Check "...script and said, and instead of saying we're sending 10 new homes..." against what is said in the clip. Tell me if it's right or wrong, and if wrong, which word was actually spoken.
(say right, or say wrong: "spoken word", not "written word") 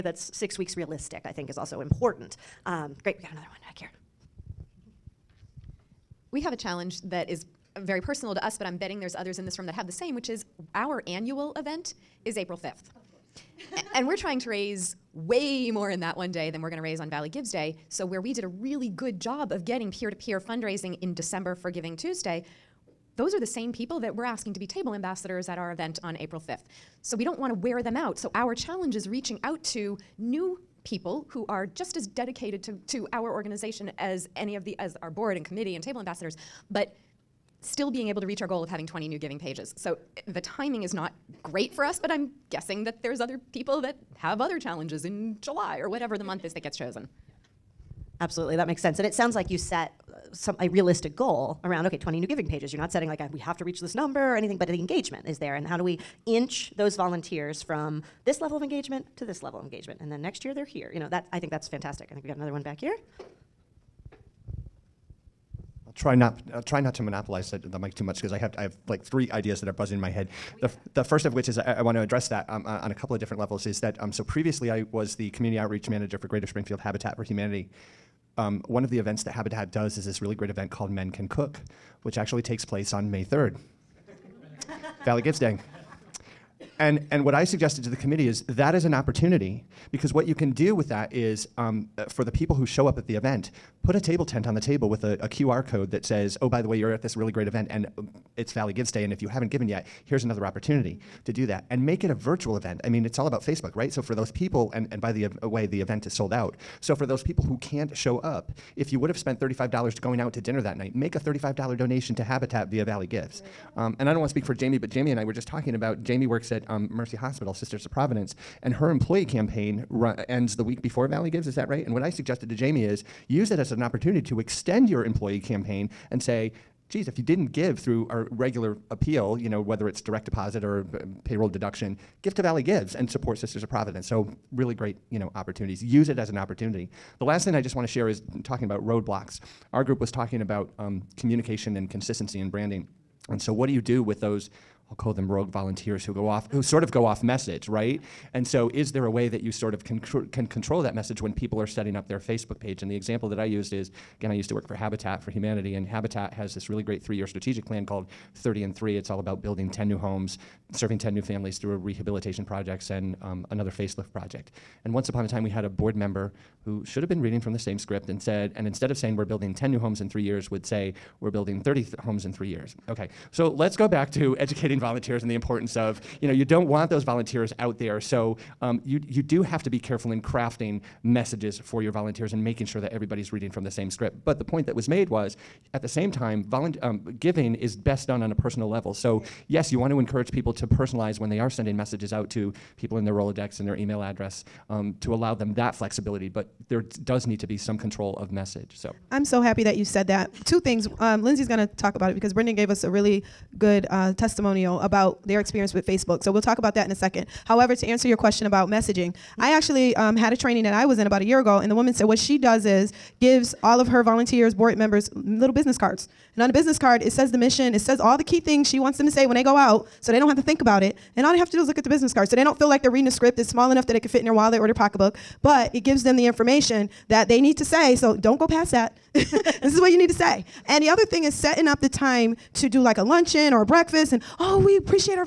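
wrong: "building", not "sending".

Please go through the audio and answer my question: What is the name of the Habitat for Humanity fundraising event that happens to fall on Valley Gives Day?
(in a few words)
Men Can Cook.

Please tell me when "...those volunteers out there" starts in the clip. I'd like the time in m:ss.
2:56.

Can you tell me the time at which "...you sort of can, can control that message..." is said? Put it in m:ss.
2:29.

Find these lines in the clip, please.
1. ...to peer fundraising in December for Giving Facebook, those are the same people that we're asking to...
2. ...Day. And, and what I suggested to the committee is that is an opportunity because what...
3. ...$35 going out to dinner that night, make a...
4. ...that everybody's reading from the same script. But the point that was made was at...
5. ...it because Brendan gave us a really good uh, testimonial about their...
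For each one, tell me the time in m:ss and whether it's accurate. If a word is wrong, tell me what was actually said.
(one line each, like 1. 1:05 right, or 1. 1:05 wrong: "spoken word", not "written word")
1. 0:20 wrong: "Tuesday", not "Facebook"
2. 1:25 right
3. 1:49 right
4. 3:02 right
5. 3:22 right.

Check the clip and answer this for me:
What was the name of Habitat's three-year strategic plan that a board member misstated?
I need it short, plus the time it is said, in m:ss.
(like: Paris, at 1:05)
30 and 3, at 2:38.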